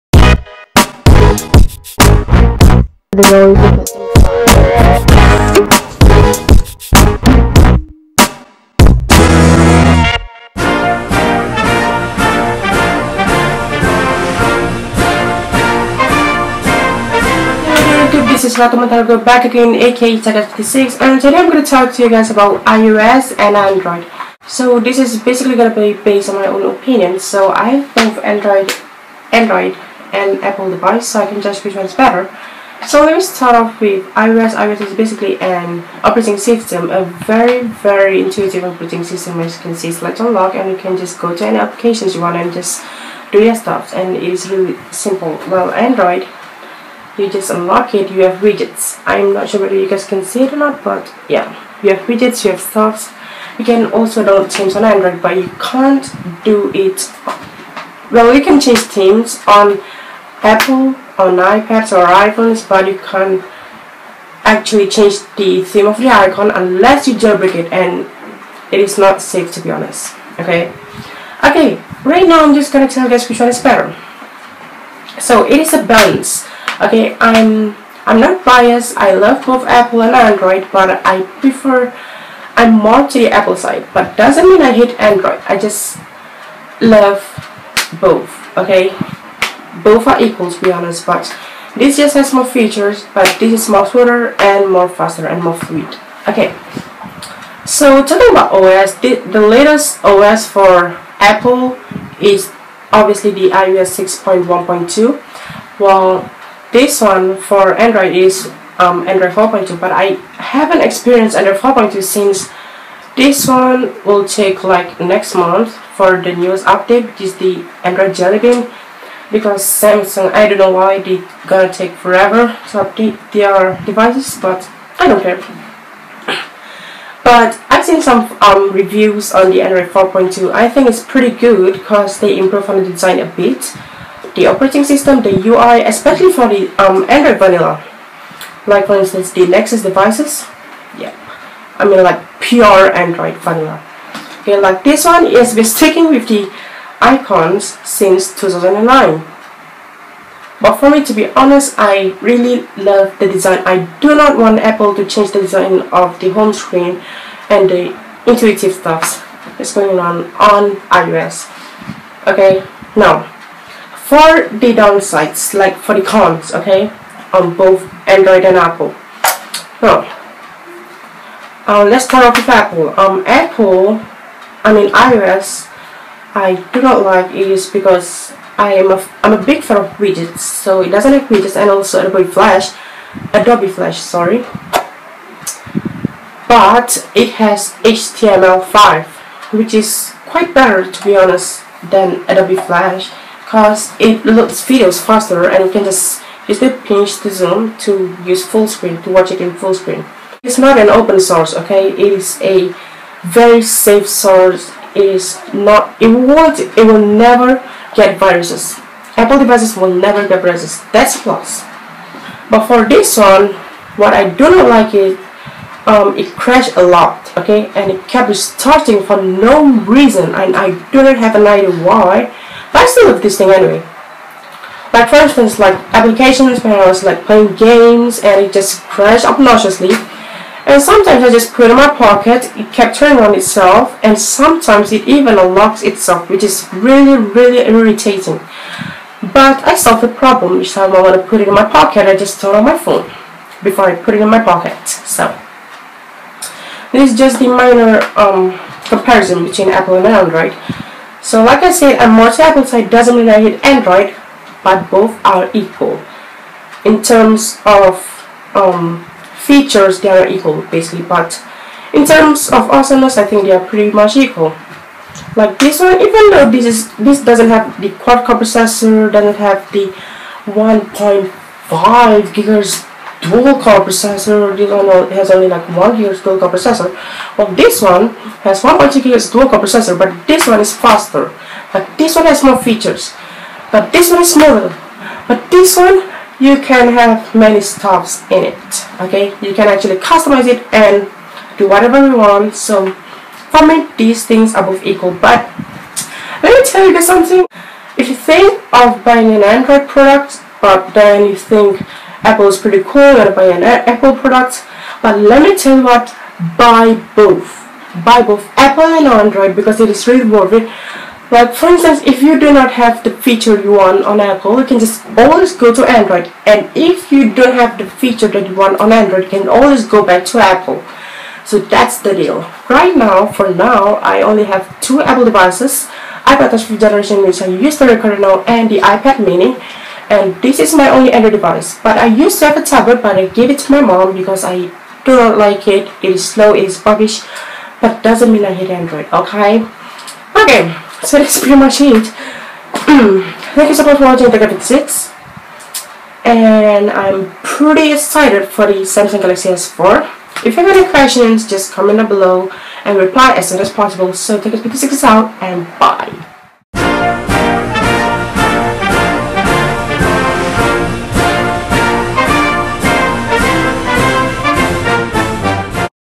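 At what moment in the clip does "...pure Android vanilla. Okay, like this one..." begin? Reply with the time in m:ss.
2:22.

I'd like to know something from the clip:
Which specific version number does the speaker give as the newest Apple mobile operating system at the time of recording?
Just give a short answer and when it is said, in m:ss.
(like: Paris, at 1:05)
iOS 6.1.2, at 1:43.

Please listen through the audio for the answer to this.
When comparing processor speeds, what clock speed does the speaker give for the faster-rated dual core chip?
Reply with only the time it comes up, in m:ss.
4:38.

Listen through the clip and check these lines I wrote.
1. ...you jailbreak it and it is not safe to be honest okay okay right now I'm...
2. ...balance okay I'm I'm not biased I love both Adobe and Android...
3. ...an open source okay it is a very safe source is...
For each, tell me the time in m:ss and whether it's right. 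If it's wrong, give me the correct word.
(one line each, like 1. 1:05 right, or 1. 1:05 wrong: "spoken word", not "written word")
1. 1:07 right
2. 1:15 wrong: "Apple", not "Adobe"
3. 3:20 right.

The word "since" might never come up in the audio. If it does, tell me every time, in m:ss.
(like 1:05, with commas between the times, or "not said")
1:52, 2:27.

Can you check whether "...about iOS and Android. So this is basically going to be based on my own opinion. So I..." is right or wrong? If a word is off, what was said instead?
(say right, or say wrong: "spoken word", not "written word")
right.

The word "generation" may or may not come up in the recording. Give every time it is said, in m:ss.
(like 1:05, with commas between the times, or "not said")
5:26.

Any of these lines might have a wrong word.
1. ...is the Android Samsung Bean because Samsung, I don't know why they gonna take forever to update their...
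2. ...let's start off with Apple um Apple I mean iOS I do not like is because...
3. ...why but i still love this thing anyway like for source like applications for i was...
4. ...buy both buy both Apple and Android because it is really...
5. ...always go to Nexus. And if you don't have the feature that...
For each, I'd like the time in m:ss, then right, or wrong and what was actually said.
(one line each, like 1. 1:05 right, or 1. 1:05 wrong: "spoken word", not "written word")
1. 1:57 wrong: "Jelly", not "Samsung"
2. 2:51 right
3. 3:41 wrong: "instance", not "source"
4. 5:06 right
5. 5:15 wrong: "Android", not "Nexus".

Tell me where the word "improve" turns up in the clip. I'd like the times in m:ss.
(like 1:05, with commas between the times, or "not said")
2:12.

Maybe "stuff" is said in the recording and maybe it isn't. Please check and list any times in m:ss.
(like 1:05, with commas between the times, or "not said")
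0:43, 0:52, 2:38, 4:47.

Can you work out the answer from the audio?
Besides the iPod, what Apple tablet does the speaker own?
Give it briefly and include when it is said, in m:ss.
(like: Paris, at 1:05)
iPad mini, at 5:28.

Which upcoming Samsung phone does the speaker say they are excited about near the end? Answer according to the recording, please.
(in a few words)
Samsung Galaxy S4.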